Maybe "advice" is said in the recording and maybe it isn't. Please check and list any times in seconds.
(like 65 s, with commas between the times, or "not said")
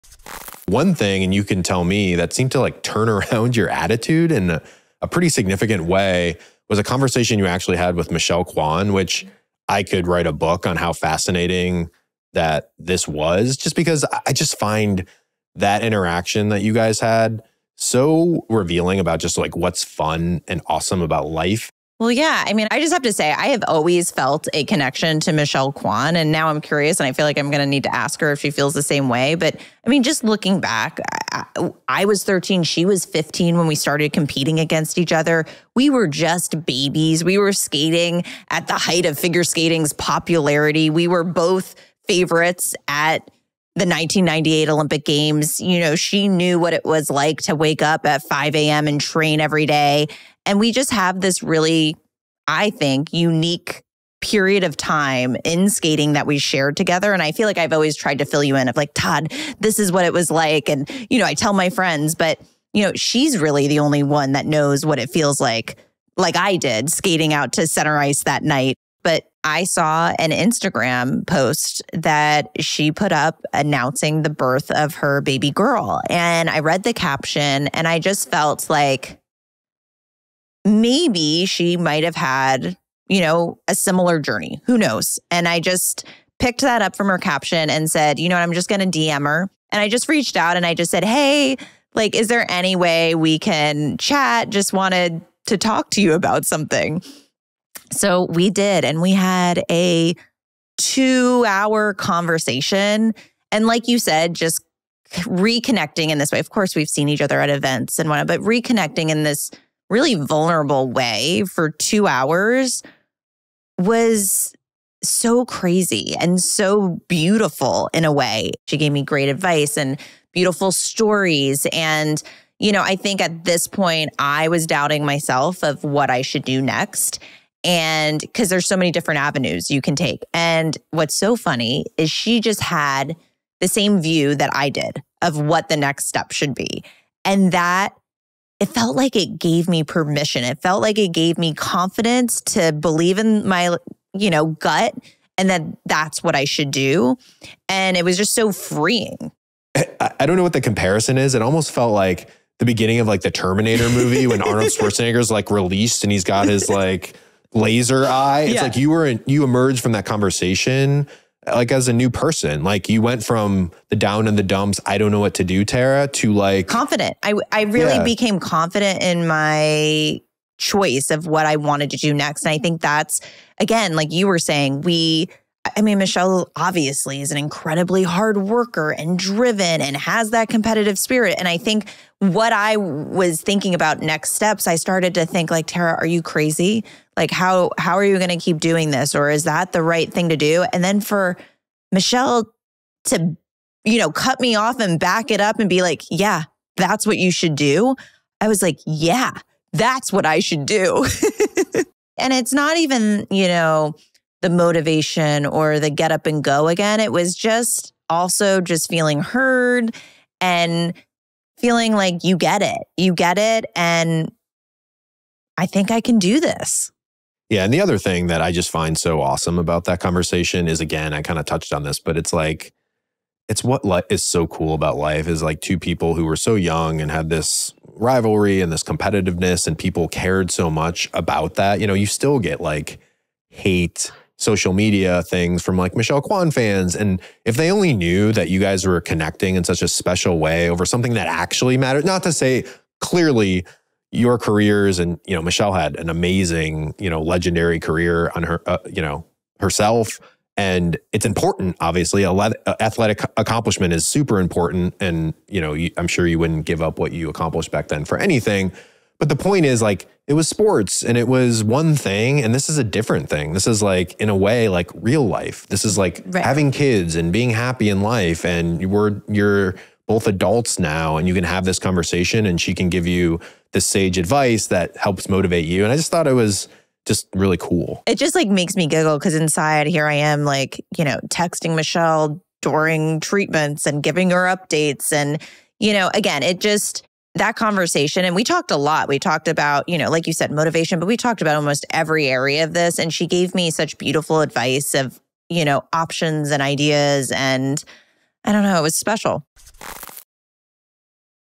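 119 s, 274 s, 294 s.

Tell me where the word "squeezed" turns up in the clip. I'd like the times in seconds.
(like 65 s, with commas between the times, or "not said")
not said.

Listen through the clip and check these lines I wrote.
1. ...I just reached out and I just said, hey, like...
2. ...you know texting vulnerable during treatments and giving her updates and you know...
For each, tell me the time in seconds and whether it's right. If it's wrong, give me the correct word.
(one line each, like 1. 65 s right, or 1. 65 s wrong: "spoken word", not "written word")
1. 89 s right
2. 280 s wrong: "michelle", not "vulnerable".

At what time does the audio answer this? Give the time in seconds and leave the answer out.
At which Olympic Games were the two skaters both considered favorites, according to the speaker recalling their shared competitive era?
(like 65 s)
43 s.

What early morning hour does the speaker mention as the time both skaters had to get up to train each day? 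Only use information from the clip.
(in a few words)
5 a.m.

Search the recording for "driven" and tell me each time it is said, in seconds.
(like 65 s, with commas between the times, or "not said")
179 s.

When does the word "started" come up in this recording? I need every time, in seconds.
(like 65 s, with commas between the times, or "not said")
33 s, 184 s.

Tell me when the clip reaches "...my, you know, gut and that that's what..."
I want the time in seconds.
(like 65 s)
143 s.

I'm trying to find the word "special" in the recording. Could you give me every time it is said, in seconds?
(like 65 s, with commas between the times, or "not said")
239 s, 298 s.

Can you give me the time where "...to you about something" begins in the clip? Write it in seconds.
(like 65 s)
95 s.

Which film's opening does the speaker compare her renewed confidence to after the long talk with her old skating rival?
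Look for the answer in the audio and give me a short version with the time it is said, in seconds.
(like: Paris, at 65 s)
The Terminator, at 153 s.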